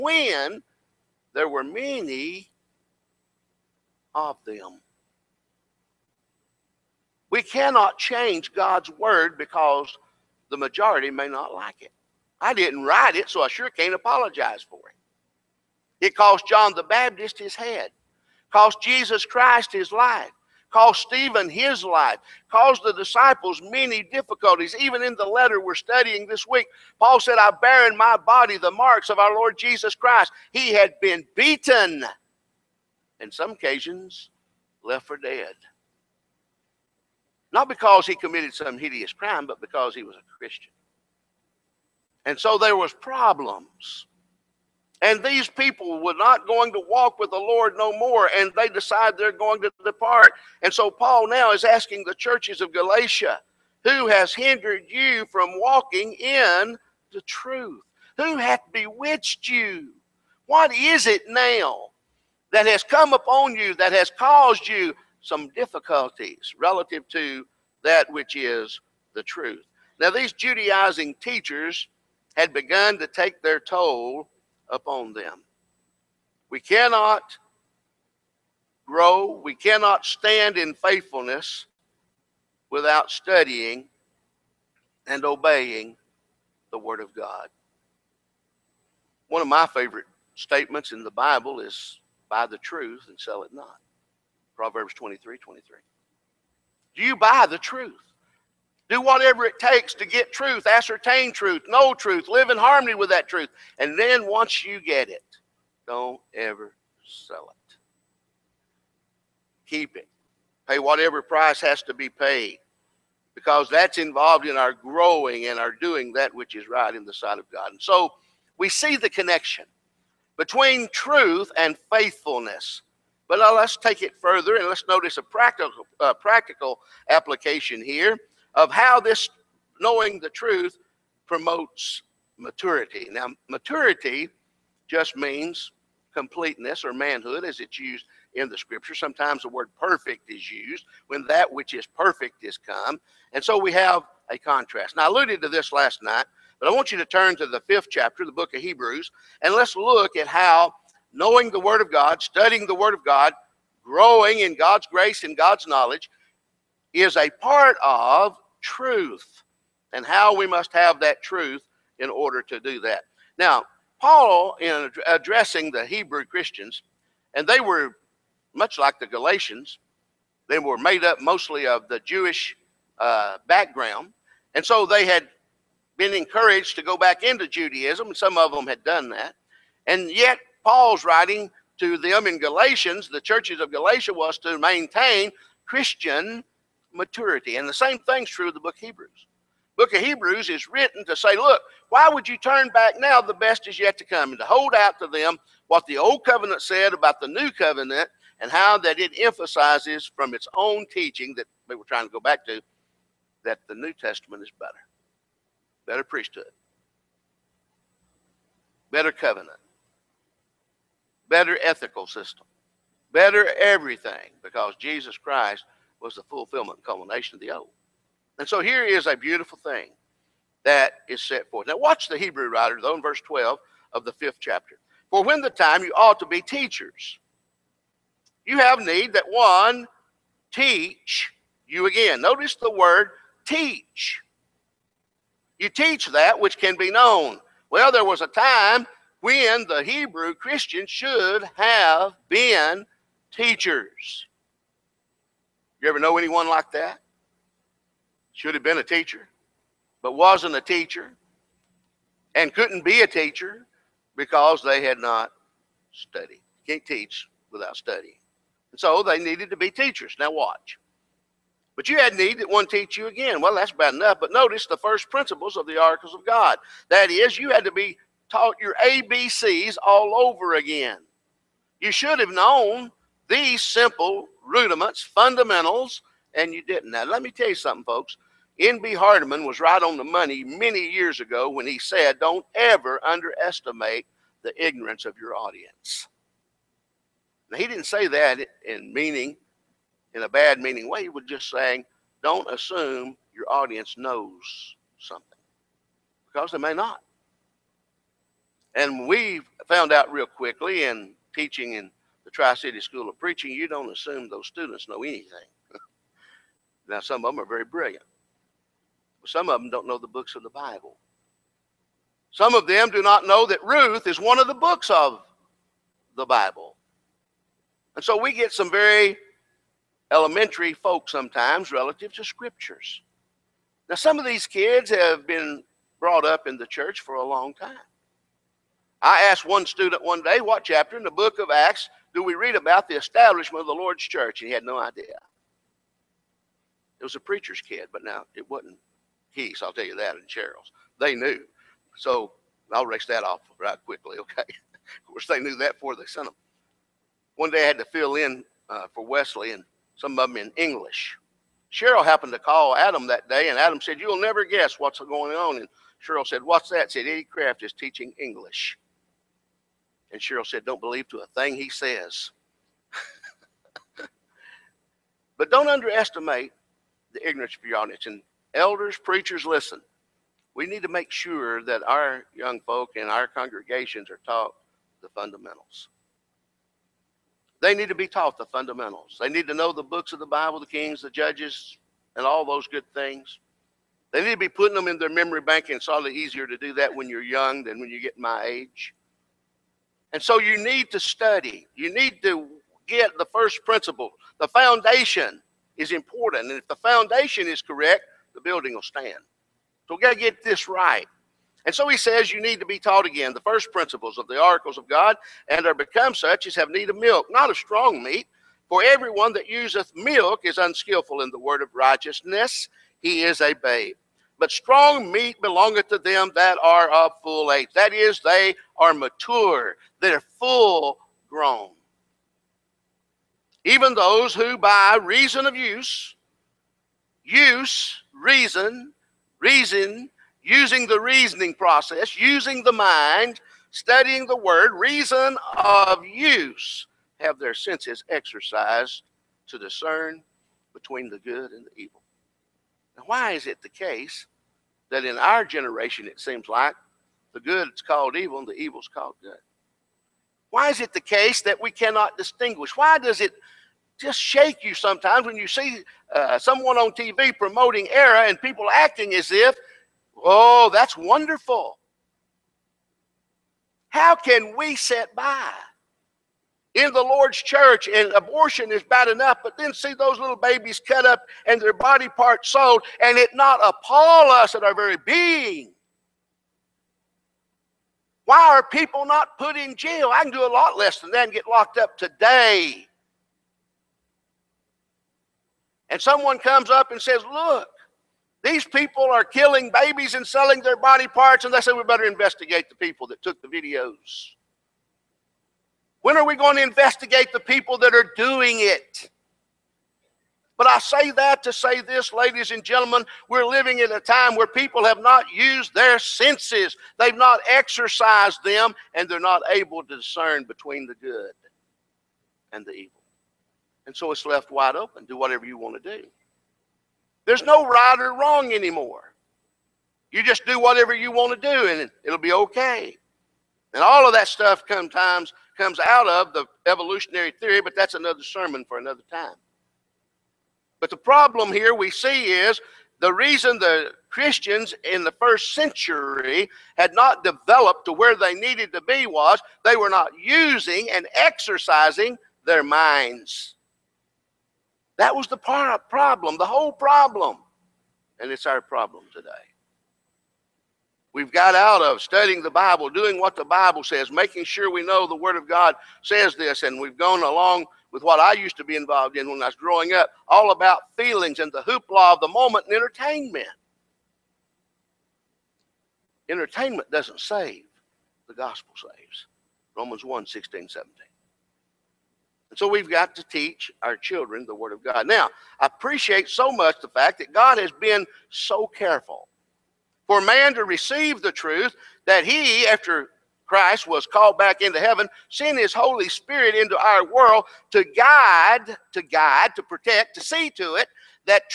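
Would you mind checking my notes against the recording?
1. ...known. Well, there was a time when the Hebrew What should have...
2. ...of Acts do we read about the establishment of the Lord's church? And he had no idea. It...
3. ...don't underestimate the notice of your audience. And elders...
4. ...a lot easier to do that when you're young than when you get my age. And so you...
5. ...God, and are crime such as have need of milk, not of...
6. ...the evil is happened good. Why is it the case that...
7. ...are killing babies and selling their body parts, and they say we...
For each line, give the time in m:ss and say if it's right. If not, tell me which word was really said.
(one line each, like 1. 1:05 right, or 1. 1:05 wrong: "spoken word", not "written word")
1. 3:56 wrong: "Christians", not "What"
2. 5:31 right
3. 6:05 wrong: "ignorance", not "notice"
4. 6:25 right
5. 6:44 wrong: "become", not "crime"
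6. 7:28 wrong: "called", not "happened"
7. 8:09 right.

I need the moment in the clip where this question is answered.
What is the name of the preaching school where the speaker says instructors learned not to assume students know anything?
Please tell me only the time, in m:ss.
5:02.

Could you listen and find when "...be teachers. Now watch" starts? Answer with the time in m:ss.
4:19.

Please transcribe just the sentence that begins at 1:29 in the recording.
One of my favorite statements in the Bible is buy the truth and sell it not.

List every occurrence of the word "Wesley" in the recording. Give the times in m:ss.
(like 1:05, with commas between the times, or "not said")
5:49.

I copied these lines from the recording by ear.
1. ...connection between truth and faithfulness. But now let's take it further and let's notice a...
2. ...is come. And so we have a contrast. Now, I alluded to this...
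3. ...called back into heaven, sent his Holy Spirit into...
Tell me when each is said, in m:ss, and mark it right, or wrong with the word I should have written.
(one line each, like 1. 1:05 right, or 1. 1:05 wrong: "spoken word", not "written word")
1. 1:59 right
2. 2:22 right
3. 9:44 right.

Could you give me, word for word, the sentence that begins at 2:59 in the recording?
And yet, Paul's writing to them in Galatians, the churches of Galatia, was to maintain Christian maturity.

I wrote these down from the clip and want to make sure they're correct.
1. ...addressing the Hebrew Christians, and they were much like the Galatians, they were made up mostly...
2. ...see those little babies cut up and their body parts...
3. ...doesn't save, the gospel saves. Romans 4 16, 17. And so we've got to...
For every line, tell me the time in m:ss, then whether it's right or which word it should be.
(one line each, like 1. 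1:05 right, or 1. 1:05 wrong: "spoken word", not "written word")
1. 2:45 right
2. 7:49 right
3. 9:26 wrong: "1", not "4".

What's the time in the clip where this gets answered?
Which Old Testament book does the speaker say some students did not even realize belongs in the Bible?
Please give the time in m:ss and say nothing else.
5:13.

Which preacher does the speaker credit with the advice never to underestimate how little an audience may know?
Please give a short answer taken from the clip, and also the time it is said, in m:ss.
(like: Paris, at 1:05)
N.B. Hardeman, at 4:38.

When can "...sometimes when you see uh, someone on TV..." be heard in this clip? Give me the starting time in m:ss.
7:34.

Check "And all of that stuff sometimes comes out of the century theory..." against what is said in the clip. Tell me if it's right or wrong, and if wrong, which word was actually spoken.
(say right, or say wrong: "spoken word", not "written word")
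wrong: "evolutionary", not "century".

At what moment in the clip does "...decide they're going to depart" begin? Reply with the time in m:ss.
0:48.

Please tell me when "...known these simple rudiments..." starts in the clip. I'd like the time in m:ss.
4:32.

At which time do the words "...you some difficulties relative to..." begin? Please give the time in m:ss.
1:04.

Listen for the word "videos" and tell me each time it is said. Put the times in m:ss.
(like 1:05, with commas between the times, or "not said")
8:13.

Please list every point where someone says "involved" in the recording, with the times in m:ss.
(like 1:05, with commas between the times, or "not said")
1:53, 9:18.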